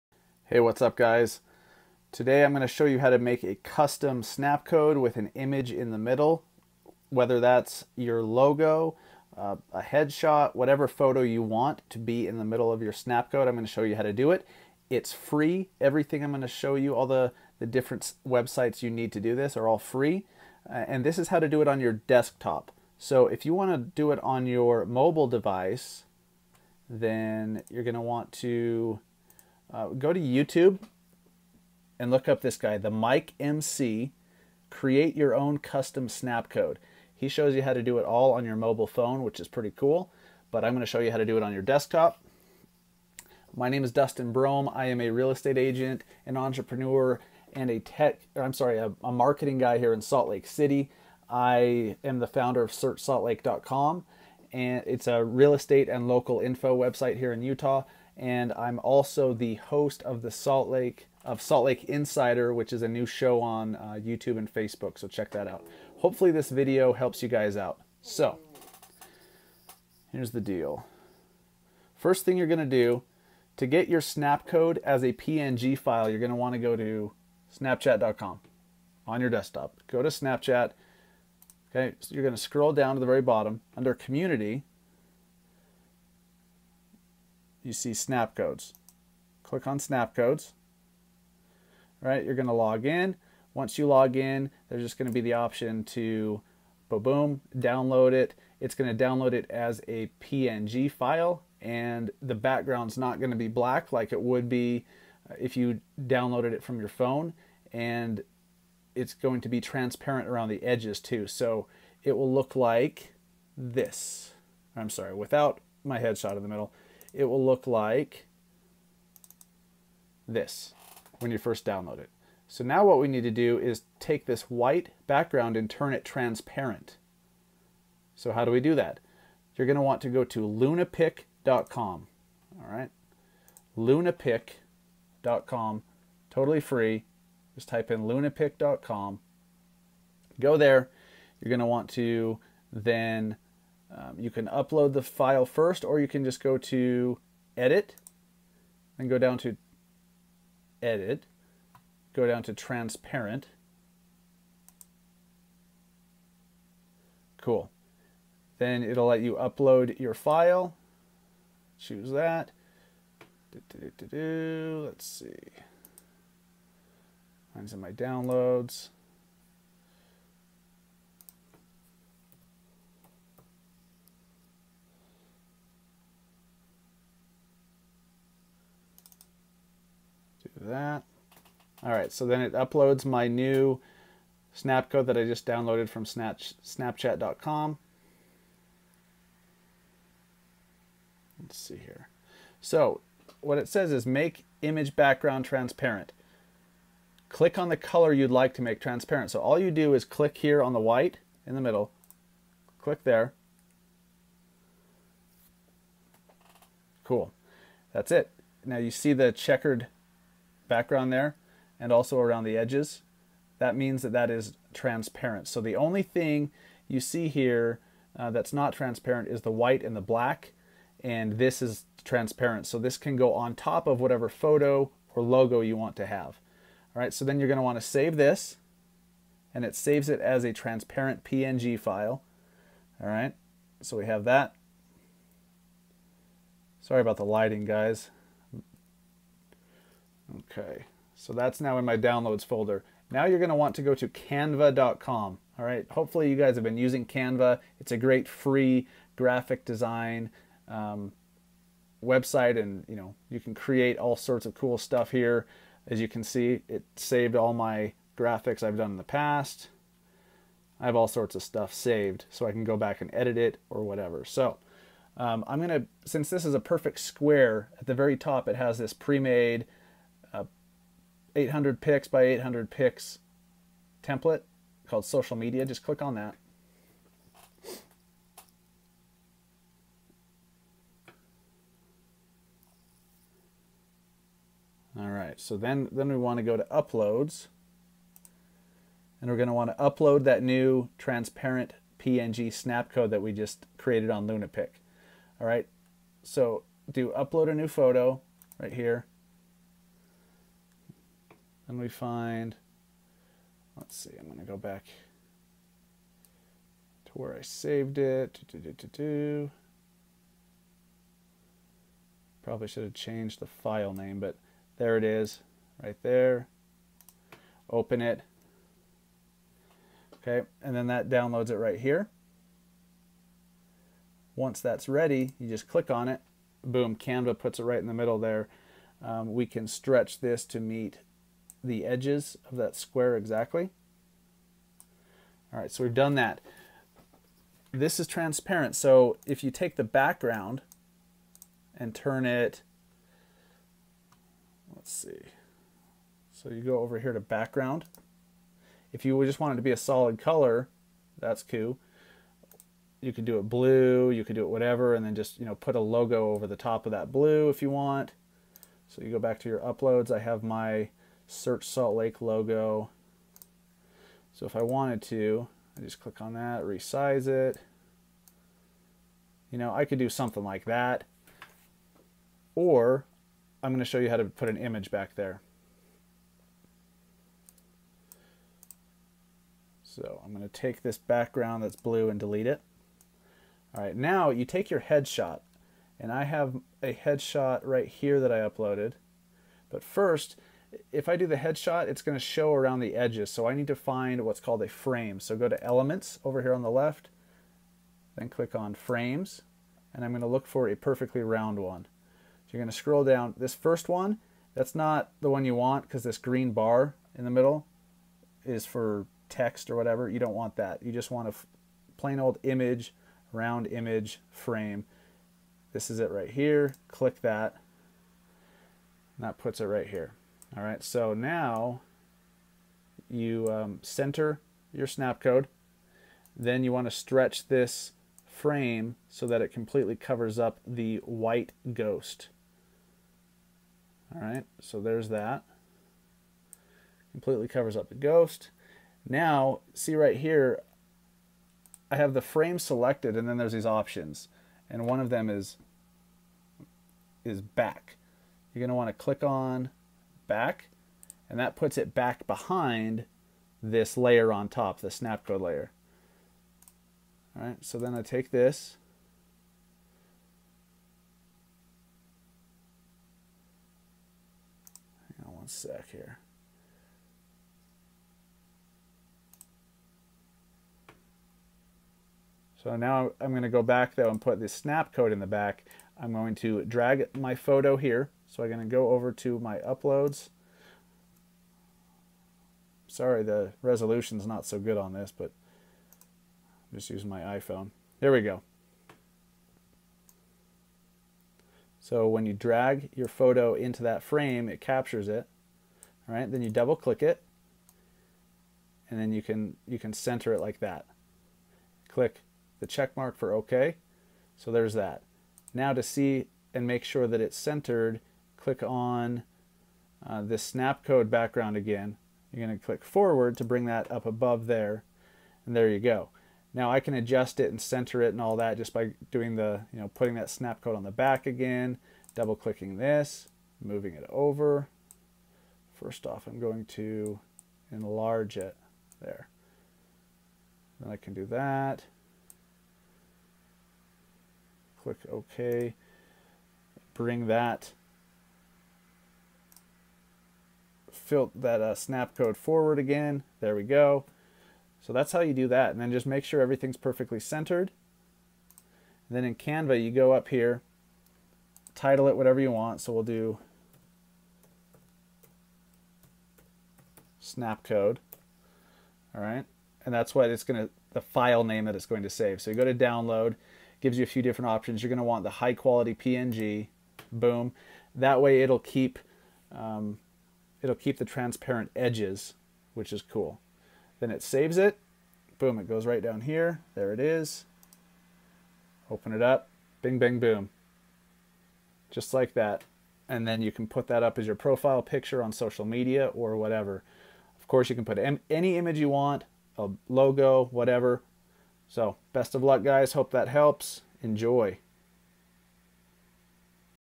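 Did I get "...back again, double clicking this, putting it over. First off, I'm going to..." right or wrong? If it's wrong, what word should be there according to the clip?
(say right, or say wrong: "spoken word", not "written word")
wrong: "moving", not "putting".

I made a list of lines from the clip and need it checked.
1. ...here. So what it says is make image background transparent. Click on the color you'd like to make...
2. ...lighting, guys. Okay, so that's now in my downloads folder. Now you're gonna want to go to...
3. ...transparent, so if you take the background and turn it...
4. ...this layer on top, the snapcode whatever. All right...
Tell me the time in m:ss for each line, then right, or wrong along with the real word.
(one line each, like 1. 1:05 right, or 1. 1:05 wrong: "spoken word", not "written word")
1. 3:11 right
2. 3:57 right
3. 5:38 right
4. 7:33 wrong: "layer", not "whatever".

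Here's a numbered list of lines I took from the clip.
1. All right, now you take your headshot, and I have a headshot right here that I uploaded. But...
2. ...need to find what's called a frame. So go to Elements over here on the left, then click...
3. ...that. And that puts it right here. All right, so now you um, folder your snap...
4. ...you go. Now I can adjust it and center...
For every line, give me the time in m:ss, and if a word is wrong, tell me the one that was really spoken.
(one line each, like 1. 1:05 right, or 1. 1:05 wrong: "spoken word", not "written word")
1. 6:23 right
2. 6:33 right
3. 6:57 wrong: "center", not "folder"
4. 8:35 right.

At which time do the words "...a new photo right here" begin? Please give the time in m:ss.
4:57.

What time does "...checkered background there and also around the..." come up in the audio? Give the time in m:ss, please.
3:29.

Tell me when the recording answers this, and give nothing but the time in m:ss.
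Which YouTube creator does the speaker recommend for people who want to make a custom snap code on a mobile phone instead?
0:32.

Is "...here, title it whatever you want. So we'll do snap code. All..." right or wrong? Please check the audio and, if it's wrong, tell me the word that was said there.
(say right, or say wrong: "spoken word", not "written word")
right.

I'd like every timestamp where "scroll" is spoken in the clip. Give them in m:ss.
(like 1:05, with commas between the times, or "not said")
1:22, 6:42.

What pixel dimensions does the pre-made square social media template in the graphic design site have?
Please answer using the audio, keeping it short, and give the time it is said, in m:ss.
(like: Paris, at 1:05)
800 by 800, at 4:31.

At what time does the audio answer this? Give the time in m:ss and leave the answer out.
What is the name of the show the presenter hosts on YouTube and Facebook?
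1:01.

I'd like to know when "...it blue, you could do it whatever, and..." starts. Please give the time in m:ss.
5:53.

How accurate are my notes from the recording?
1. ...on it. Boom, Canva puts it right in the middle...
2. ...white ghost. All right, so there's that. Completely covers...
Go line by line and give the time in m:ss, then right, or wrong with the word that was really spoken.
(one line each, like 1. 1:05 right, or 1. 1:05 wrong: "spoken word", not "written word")
1. 5:25 right
2. 7:11 right.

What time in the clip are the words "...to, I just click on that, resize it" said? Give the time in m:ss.
6:05.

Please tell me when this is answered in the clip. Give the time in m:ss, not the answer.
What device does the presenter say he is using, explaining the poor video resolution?
8:07.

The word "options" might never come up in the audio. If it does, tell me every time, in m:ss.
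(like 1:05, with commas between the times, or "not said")
1:35, 7:23, 9:24.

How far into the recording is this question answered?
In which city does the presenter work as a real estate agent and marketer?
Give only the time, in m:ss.
0:50.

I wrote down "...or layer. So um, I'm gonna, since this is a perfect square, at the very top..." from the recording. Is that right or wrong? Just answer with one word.
wrong.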